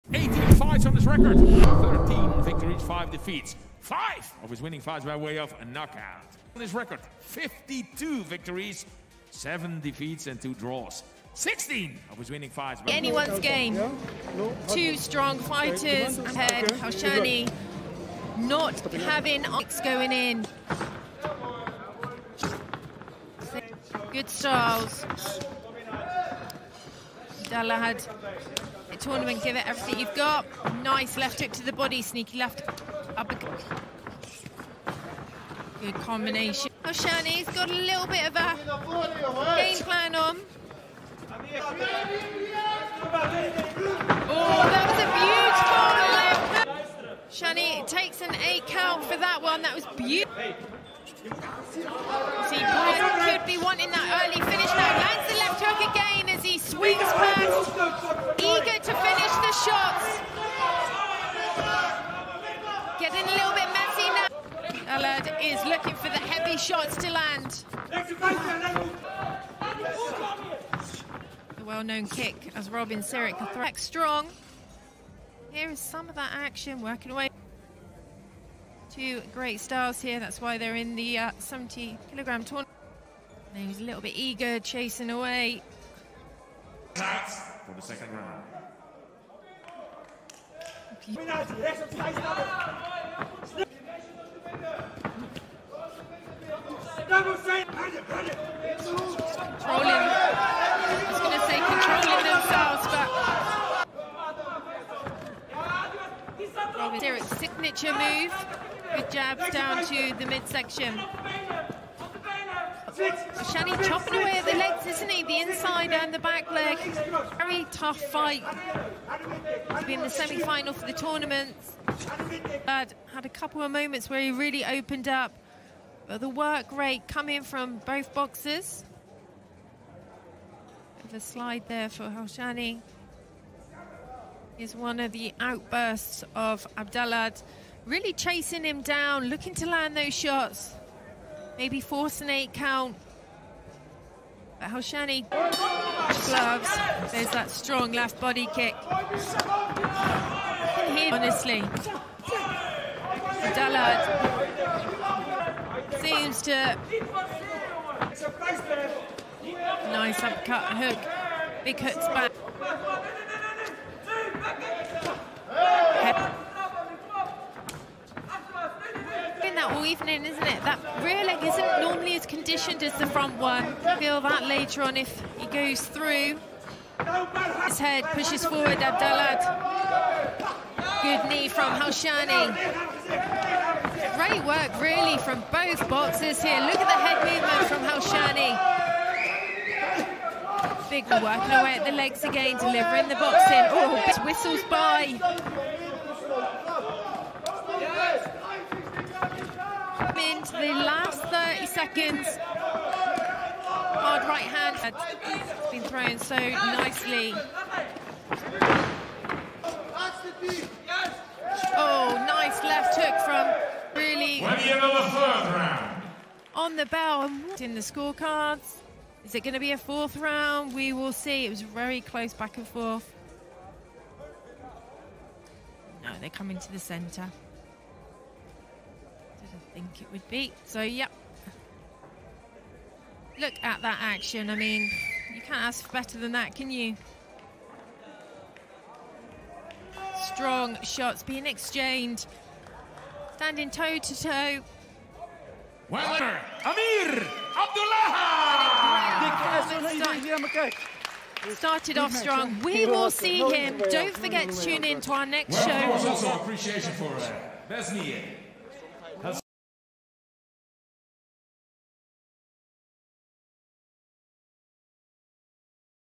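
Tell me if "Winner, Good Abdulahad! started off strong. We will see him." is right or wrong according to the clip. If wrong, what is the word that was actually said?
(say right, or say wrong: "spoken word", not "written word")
wrong: "Amir", not "Good".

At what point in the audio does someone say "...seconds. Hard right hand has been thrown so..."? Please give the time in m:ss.
3:21.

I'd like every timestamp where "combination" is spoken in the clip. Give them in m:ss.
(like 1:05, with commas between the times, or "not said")
0:35.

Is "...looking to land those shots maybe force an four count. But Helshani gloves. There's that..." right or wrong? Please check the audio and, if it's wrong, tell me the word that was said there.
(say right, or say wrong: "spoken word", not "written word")
wrong: "eight", not "four".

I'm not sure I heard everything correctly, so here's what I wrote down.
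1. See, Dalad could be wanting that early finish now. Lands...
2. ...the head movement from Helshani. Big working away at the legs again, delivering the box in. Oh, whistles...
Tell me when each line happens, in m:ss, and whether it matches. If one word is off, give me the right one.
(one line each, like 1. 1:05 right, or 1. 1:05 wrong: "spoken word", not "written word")
1. 0:51 wrong: "Pyatt", not "Dalad"
2. 3:06 right.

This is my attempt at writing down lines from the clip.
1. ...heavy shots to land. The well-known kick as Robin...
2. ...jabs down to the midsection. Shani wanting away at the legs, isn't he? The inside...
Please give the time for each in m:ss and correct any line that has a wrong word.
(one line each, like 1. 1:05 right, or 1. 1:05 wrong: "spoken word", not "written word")
1. 1:06 right
2. 1:49 wrong: "chopping", not "wanting".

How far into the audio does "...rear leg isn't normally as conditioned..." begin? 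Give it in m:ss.
2:51.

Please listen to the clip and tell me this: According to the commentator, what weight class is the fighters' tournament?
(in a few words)
70 kilograms.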